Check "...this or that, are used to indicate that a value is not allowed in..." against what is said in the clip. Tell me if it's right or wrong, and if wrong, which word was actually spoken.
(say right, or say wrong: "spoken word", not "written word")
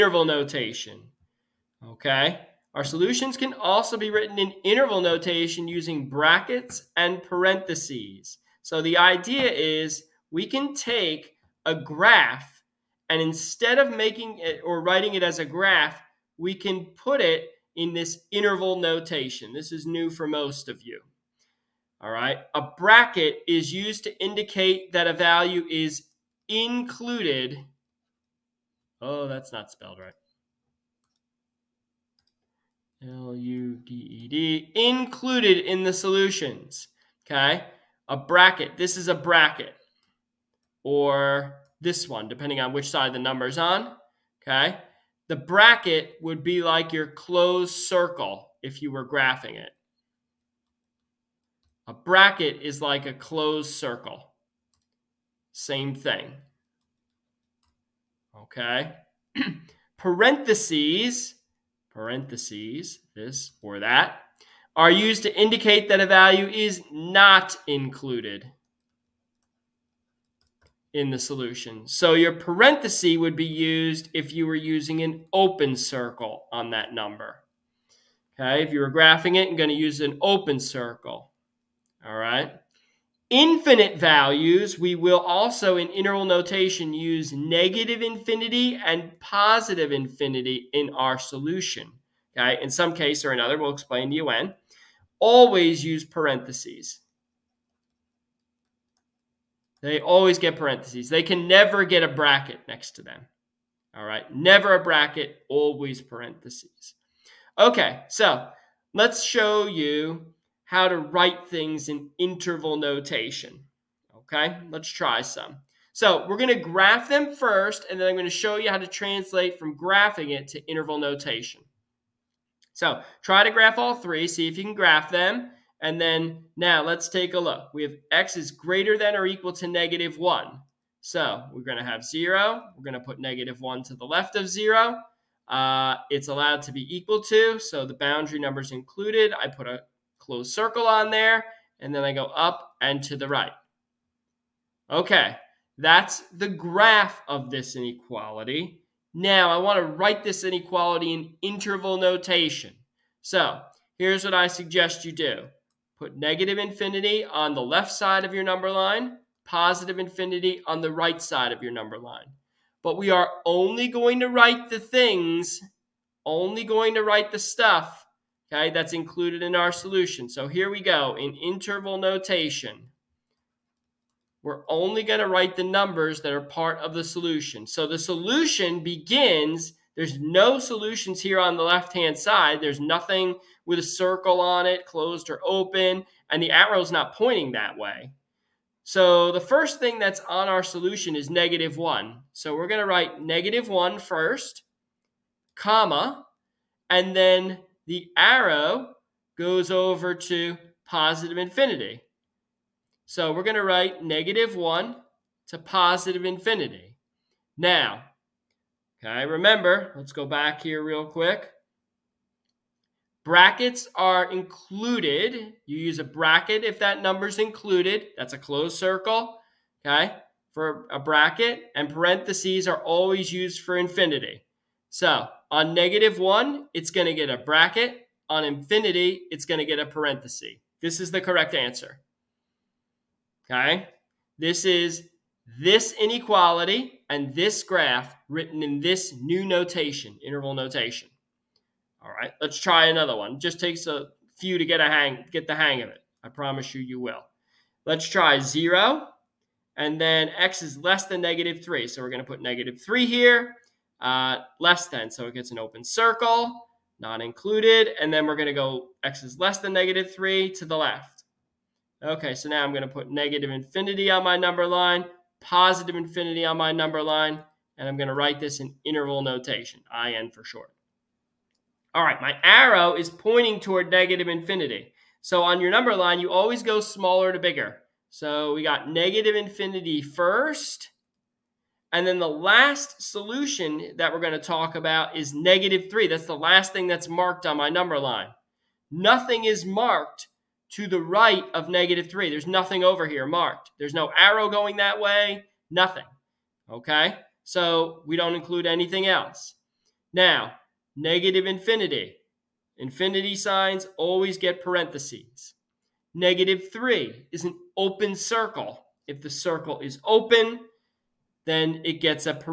wrong: "included", not "allowed".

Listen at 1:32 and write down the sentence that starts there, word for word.
Okay, in some case or another, we'll explain to you when always use parentheses.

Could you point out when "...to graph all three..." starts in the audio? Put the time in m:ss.
2:03.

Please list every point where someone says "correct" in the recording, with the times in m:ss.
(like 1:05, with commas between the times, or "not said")
3:51.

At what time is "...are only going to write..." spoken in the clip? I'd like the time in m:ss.
2:43.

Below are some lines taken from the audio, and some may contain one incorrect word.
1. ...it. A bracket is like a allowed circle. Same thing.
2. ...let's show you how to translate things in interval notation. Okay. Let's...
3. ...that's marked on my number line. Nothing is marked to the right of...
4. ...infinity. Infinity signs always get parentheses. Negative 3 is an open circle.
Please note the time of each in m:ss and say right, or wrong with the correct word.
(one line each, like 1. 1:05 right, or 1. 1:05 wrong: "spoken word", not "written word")
1. 0:49 wrong: "closed", not "allowed"
2. 1:48 wrong: "write", not "translate"
3. 4:46 right
4. 5:01 right.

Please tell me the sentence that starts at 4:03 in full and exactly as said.
just takes a few to get a hang, get the hang of it.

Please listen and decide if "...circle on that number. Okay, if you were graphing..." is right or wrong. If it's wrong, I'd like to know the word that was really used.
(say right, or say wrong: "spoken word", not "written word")
right.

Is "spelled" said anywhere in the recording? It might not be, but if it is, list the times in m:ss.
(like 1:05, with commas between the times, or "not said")
0:29.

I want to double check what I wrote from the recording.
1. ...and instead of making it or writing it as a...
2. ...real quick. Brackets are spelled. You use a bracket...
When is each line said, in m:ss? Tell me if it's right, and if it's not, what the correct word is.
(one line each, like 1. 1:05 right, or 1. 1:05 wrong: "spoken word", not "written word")
1. 0:13 right
2. 3:30 wrong: "included", not "spelled".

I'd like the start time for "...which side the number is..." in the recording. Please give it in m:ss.
0:42.